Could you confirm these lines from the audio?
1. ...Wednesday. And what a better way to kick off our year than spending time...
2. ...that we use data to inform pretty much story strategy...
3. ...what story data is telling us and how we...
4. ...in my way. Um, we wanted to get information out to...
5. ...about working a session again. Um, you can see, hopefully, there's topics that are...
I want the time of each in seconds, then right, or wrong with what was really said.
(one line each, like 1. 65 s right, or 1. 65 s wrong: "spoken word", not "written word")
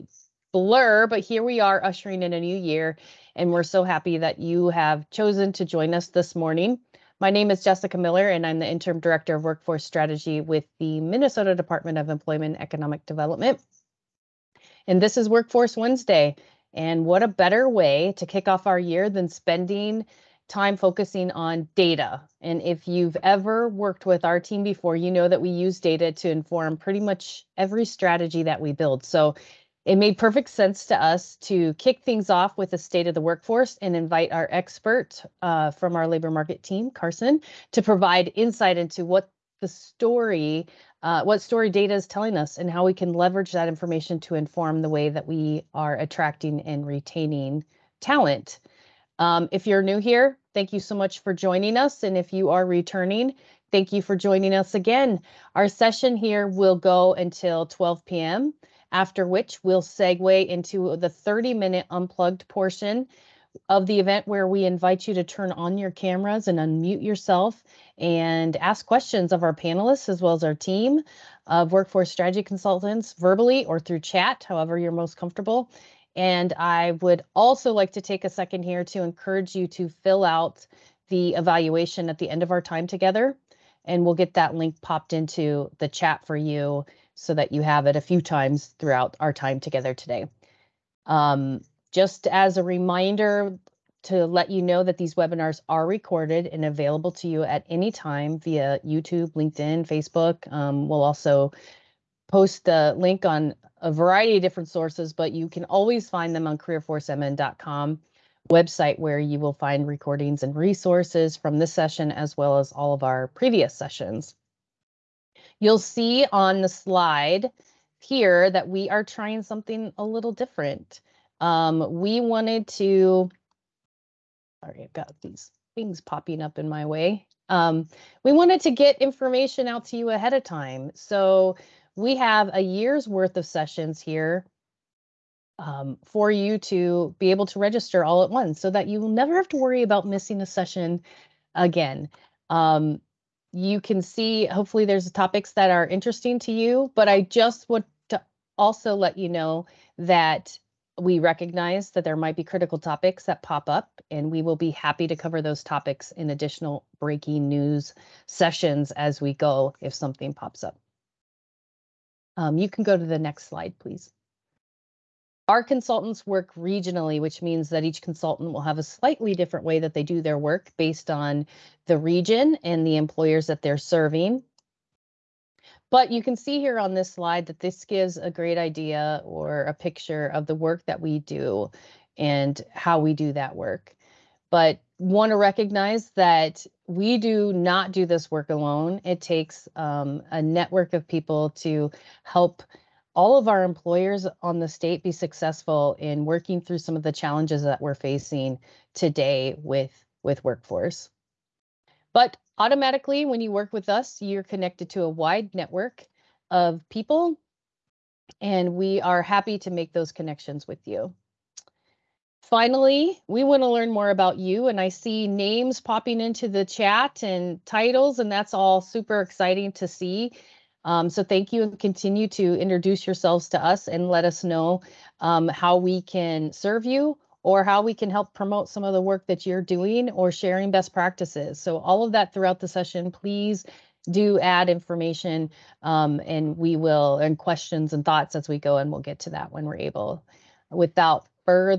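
1. 15 s right
2. 25 s wrong: "every", not "story"
3. 41 s right
4. 126 s right
5. 139 s wrong: "missing", not "working".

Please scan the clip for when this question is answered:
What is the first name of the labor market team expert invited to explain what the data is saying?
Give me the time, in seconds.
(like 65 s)
36 s.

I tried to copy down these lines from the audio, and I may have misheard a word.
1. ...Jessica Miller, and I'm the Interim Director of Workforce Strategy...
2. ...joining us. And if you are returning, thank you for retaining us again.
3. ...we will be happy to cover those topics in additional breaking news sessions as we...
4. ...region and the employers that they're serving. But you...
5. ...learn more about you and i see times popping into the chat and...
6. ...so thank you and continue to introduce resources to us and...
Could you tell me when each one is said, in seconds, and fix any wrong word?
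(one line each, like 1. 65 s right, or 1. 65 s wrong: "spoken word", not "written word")
1. 7 s right
2. 51 s wrong: "joining", not "retaining"
3. 154 s right
4. 171 s right
5. 213 s wrong: "names", not "times"
6. 221 s wrong: "yourselves", not "resources".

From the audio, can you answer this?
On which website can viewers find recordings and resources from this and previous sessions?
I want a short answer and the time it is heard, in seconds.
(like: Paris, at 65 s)
careerforcemn.com, at 106 s.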